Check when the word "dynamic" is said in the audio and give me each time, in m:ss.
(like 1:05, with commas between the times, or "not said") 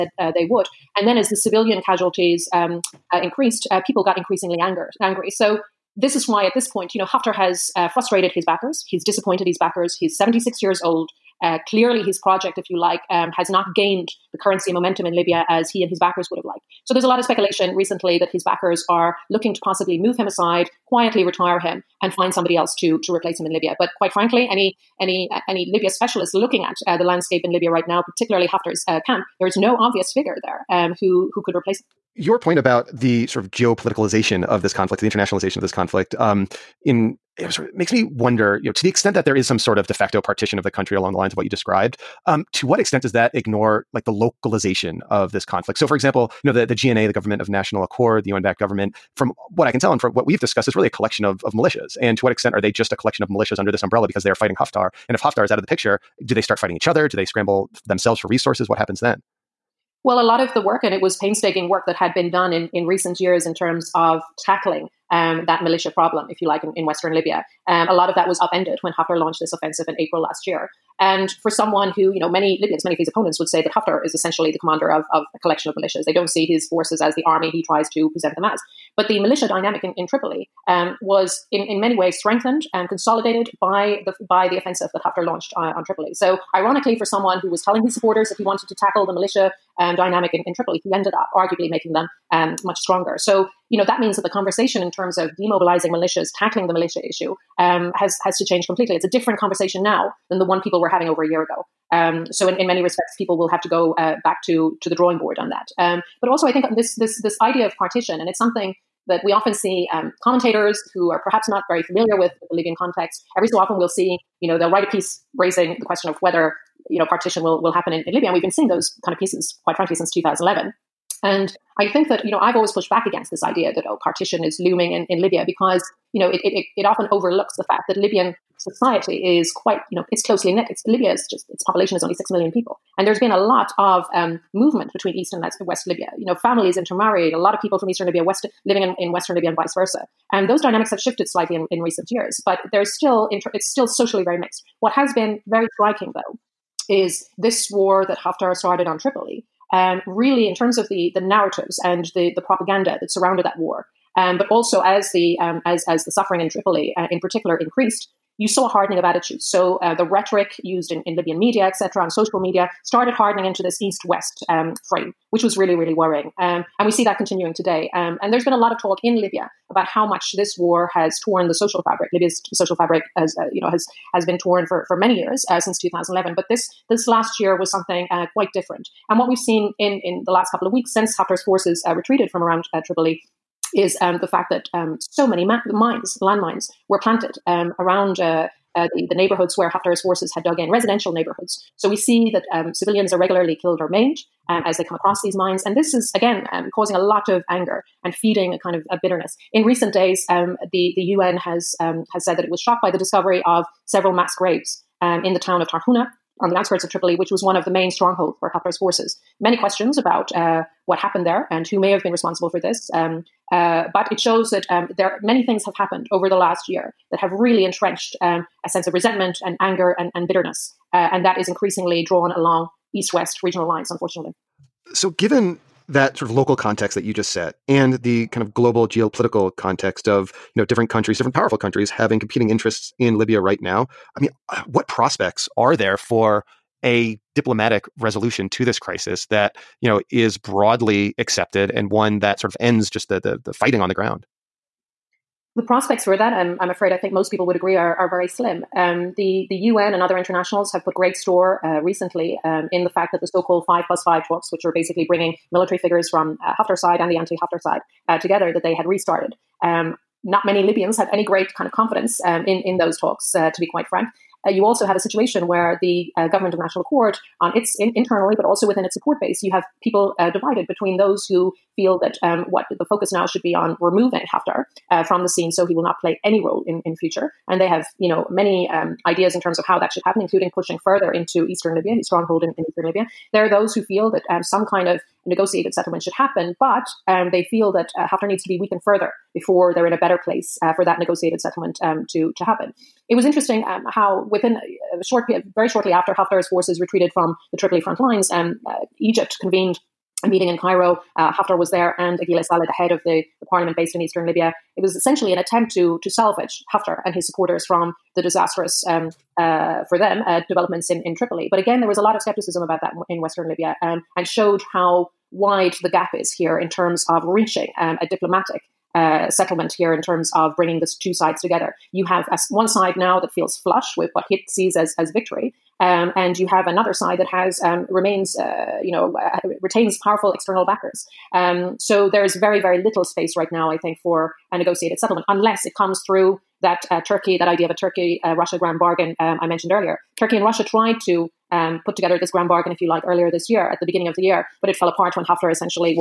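1:19, 1:29, 2:20.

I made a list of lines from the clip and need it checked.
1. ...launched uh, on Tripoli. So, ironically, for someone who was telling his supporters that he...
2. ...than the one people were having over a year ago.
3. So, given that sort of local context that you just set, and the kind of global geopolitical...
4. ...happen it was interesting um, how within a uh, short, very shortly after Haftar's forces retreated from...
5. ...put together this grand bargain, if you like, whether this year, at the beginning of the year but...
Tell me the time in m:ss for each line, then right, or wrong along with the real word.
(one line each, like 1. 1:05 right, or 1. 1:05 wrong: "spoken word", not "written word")
1. 1:25 right
2. 1:40 right
3. 3:44 right
4. 4:52 right
5. 5:41 wrong: "earlier", not "whether".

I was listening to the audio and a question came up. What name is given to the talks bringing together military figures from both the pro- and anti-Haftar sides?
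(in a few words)
five plus five talks.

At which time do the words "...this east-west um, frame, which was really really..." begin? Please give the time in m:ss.
2:43.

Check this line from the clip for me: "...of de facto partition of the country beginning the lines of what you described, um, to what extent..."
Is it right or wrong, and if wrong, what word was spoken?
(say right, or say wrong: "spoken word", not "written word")
wrong: "along", not "beginning".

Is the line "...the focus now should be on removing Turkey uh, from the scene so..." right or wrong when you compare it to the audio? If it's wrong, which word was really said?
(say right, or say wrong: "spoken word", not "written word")
wrong: "Haftar", not "Turkey".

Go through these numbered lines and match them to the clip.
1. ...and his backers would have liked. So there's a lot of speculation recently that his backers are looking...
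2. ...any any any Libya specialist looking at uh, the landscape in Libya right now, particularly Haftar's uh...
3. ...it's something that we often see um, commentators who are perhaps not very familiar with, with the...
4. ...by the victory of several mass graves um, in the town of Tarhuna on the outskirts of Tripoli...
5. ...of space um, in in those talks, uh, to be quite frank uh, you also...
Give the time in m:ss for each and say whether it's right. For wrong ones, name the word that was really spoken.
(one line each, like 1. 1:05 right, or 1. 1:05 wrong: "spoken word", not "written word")
1. 0:15 right
2. 0:24 right
3. 1:48 right
4. 3:22 wrong: "discovery", not "victory"
5. 4:21 wrong: "confidence", not "space".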